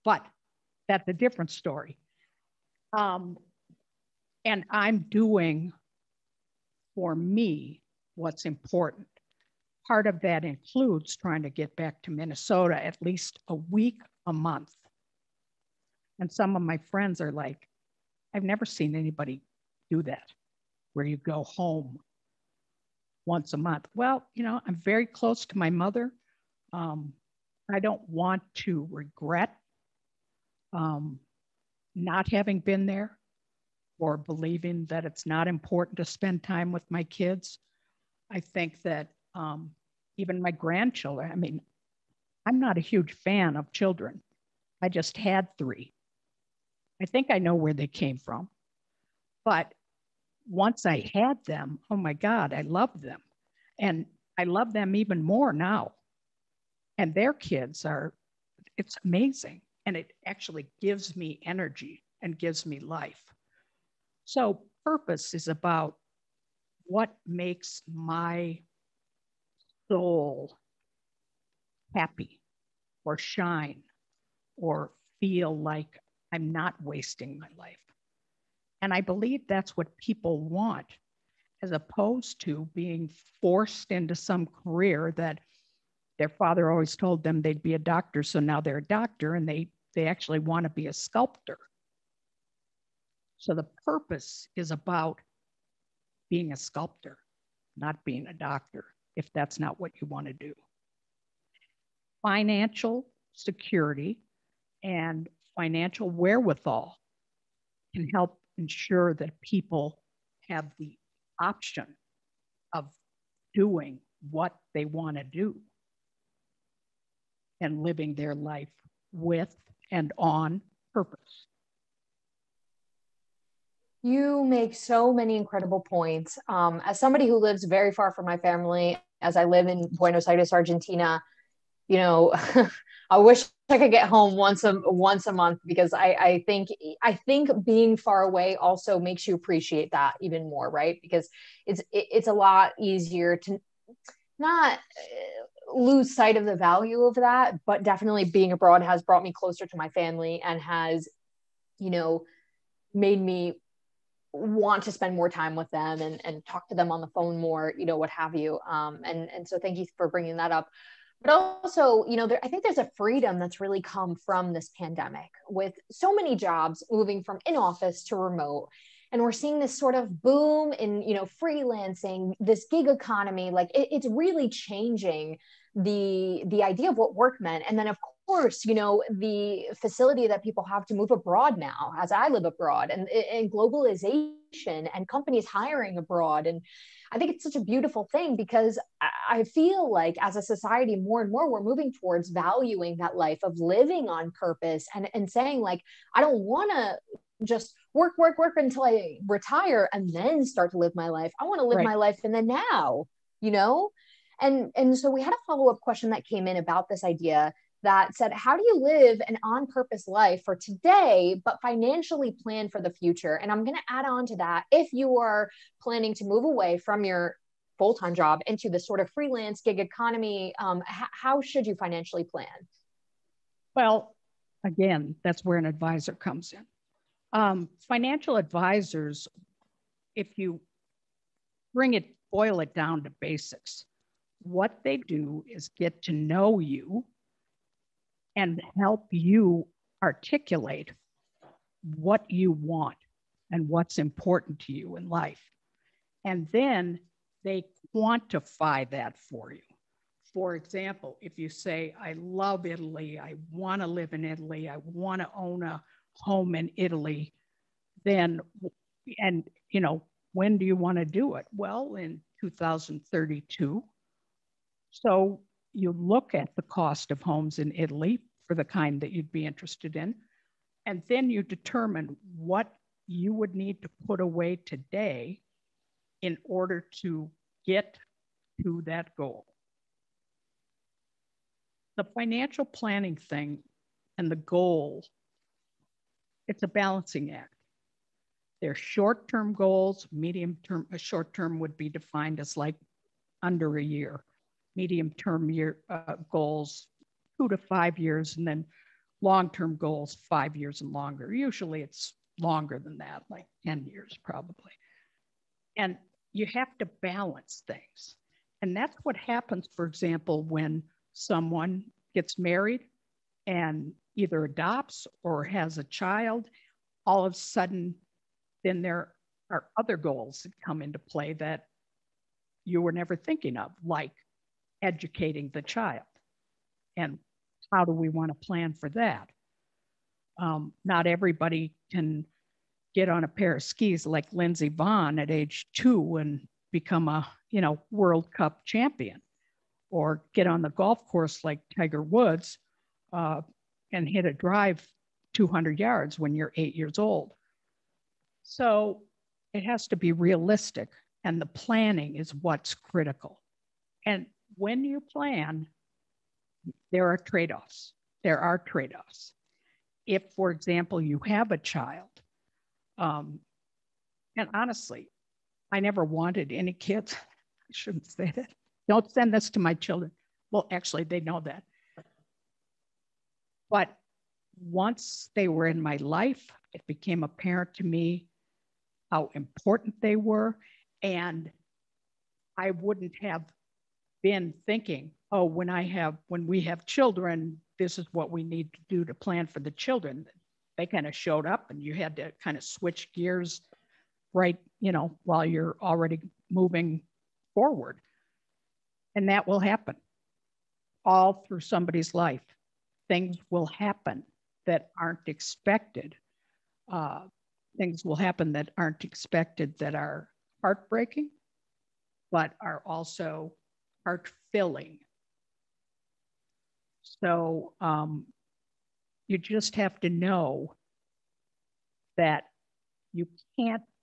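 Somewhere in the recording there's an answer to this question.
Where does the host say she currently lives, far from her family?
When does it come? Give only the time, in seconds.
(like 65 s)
129 s.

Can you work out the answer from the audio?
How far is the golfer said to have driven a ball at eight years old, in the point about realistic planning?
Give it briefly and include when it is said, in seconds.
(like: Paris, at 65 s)
200 yards, at 345 s.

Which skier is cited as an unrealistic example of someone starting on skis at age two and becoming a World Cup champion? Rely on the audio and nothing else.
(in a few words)
Lindsey Vonn.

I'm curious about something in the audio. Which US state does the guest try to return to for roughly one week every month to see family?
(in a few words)
Minnesota.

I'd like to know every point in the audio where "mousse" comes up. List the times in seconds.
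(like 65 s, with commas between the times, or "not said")
not said.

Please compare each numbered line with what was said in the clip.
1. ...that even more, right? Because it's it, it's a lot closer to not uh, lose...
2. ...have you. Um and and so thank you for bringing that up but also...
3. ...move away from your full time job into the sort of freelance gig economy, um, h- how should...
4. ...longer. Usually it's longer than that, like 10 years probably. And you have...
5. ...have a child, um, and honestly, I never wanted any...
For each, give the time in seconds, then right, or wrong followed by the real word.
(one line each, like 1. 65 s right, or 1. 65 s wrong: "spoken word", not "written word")
1. 139 s wrong: "easier", not "closer"
2. 158 s right
3. 216 s right
4. 300 s right
5. 361 s right.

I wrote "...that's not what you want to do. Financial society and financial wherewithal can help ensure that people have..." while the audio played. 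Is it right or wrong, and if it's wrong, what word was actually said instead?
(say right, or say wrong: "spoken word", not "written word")
wrong: "security", not "society".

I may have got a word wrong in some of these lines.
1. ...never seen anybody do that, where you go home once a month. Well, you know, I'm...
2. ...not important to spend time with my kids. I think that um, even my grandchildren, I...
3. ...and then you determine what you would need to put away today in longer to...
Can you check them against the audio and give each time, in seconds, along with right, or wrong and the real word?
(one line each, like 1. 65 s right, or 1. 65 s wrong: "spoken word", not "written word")
1. 18 s right
2. 35 s right
3. 270 s wrong: "order", not "longer".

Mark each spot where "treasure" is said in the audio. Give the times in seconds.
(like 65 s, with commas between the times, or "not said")
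not said.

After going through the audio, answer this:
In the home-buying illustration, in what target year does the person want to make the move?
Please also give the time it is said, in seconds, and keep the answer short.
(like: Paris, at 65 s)
2032, at 262 s.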